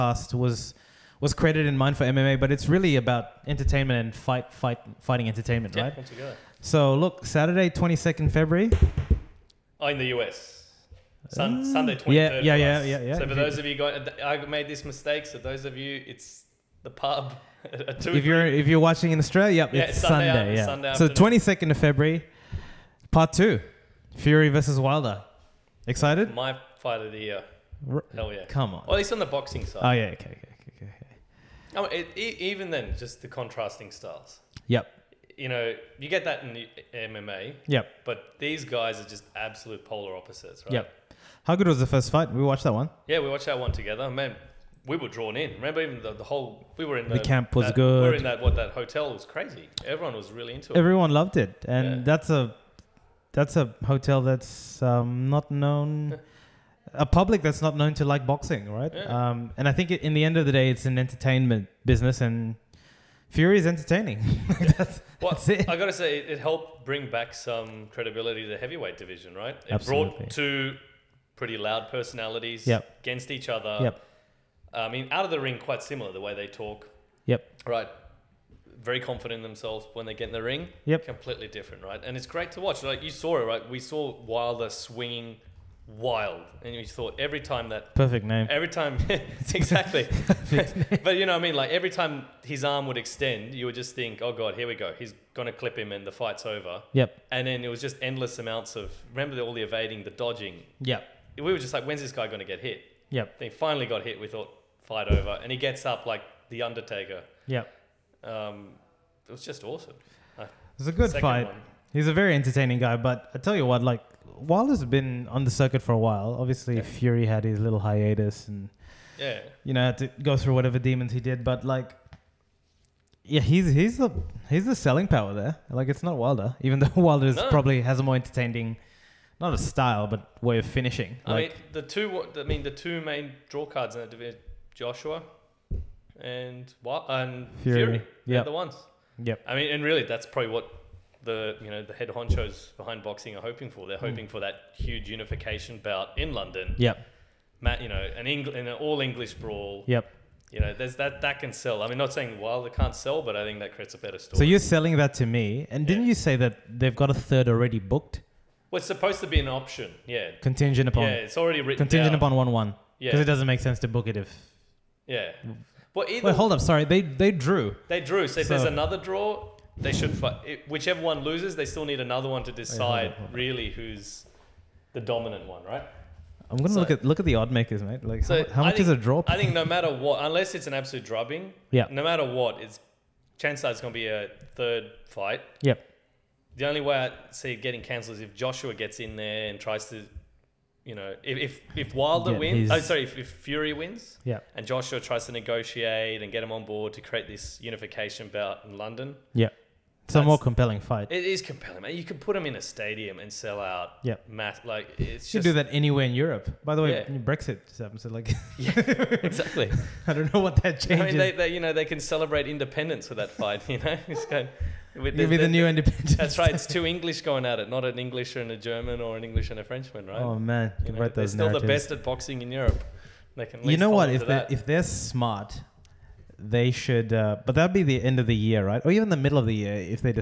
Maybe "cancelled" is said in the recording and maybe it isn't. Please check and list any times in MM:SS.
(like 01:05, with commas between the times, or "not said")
03:07.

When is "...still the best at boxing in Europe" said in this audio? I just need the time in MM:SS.
03:41.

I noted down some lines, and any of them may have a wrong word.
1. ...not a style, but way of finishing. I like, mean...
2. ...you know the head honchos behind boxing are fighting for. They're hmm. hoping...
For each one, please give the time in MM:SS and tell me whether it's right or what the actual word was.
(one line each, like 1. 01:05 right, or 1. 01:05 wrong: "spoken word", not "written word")
1. 02:09 right
2. 02:21 wrong: "hoping", not "fighting".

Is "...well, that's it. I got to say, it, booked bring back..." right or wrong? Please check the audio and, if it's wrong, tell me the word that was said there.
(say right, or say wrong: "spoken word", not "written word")
wrong: "helped", not "booked".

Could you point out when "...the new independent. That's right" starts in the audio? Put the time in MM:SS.
03:35.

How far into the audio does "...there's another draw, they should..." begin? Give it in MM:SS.
02:48.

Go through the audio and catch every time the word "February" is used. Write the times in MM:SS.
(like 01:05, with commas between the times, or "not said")
00:08, 00:21.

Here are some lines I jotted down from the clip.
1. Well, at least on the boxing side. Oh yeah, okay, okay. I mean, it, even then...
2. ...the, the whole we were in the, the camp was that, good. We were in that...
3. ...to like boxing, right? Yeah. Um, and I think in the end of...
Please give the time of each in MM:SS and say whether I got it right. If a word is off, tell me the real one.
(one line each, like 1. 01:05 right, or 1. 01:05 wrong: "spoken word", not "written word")
1. 00:28 right
2. 00:46 right
3. 00:57 right.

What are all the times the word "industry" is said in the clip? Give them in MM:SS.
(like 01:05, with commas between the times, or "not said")
not said.